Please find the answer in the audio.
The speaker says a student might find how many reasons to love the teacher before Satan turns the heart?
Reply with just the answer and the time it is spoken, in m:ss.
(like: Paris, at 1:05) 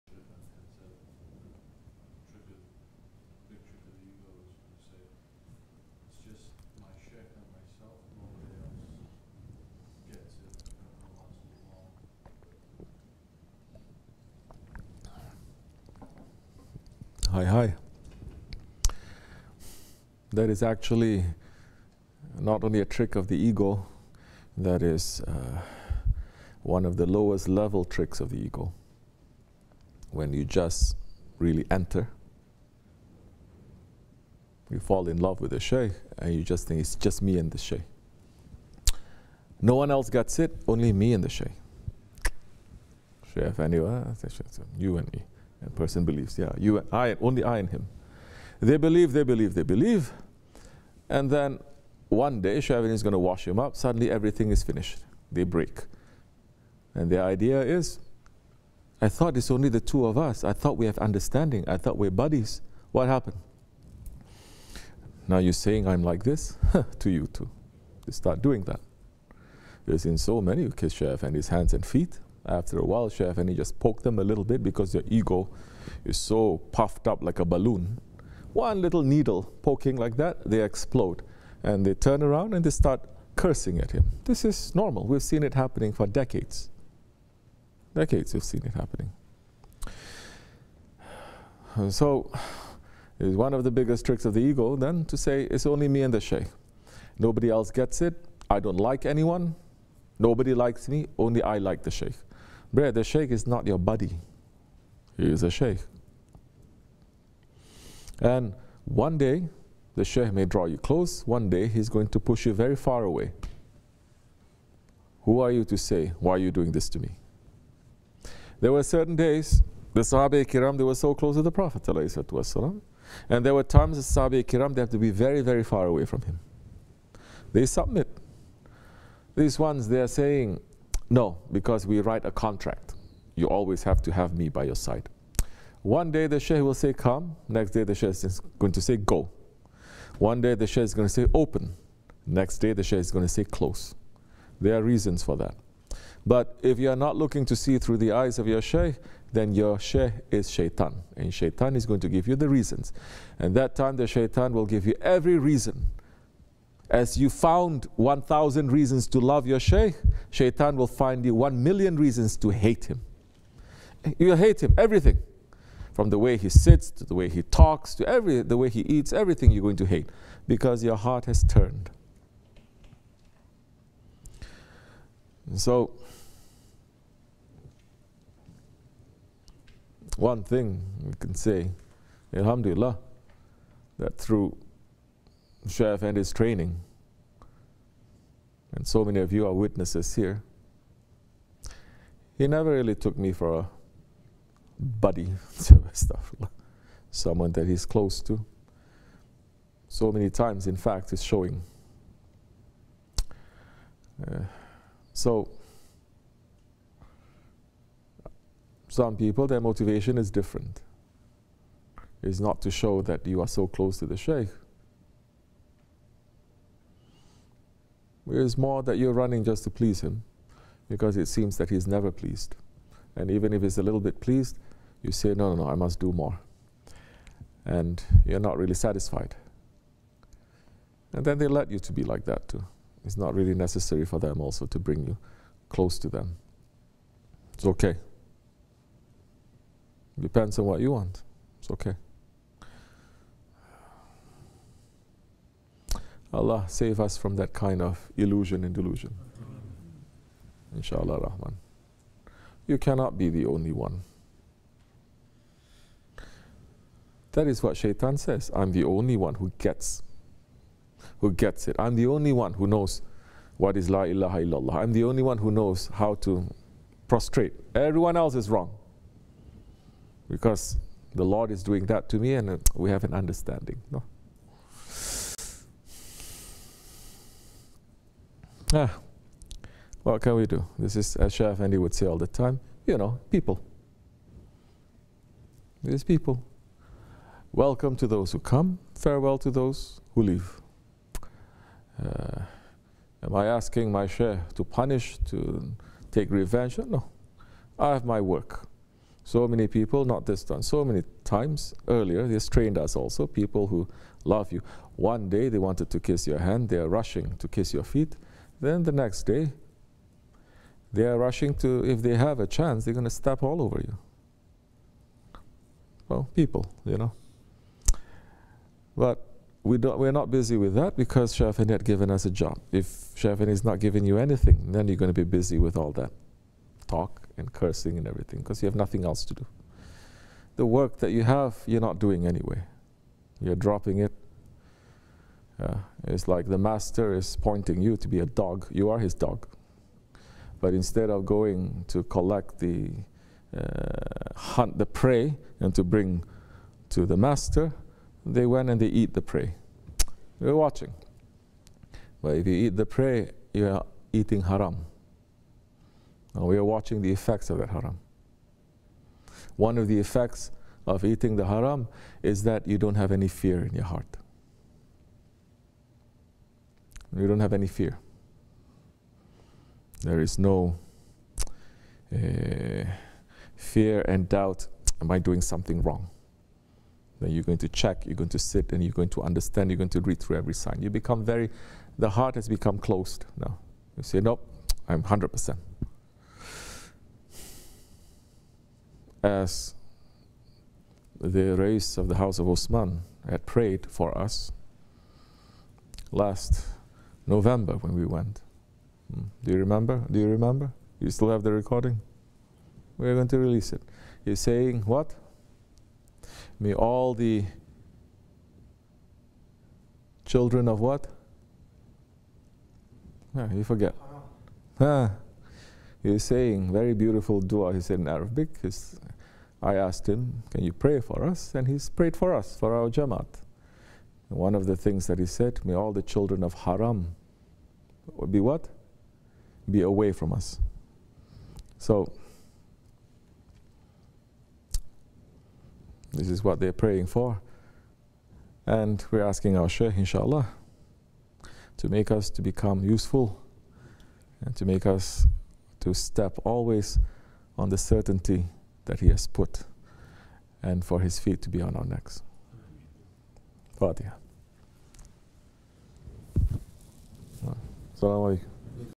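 1,000, at 2:37.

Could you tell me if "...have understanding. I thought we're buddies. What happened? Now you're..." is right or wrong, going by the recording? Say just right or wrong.
right.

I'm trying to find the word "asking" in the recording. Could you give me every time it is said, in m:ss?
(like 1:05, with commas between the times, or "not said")
4:53, 7:19.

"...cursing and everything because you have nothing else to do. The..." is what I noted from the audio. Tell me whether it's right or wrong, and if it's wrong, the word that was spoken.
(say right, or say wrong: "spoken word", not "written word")
right.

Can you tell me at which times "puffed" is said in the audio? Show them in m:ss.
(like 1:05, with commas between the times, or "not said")
1:16.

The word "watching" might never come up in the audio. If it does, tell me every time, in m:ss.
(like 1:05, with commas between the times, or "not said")
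5:50, 5:56.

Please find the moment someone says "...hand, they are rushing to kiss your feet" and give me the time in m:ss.
5:06.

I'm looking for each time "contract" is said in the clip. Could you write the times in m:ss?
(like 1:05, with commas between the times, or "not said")
2:12.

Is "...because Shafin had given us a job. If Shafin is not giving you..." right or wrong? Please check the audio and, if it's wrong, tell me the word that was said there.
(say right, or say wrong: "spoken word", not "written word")
right.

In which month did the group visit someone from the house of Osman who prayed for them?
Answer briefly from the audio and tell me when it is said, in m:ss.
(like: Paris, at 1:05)
November, at 6:37.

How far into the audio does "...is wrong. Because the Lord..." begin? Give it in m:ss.
4:28.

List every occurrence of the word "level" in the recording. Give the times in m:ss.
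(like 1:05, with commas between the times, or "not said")
0:27.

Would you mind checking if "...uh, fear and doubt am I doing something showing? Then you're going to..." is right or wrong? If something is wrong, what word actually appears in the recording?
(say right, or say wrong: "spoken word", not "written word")
wrong: "wrong", not "showing".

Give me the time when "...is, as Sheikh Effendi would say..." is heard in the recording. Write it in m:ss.
4:40.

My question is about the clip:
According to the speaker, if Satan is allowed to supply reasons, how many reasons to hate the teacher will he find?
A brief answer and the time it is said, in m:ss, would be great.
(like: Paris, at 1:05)
1 million, at 2:41.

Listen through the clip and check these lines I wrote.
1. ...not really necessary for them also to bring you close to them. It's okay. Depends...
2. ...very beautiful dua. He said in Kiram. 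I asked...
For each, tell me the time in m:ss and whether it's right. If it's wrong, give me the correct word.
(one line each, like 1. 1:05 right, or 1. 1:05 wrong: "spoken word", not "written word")
1. 3:53 right
2. 6:56 wrong: "Arabic", not "Kiram".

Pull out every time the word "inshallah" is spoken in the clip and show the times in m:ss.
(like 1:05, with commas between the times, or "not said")
4:10, 7:19.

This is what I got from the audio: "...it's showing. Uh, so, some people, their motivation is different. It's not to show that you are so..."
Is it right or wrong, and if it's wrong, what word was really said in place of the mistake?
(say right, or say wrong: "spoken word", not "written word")
right.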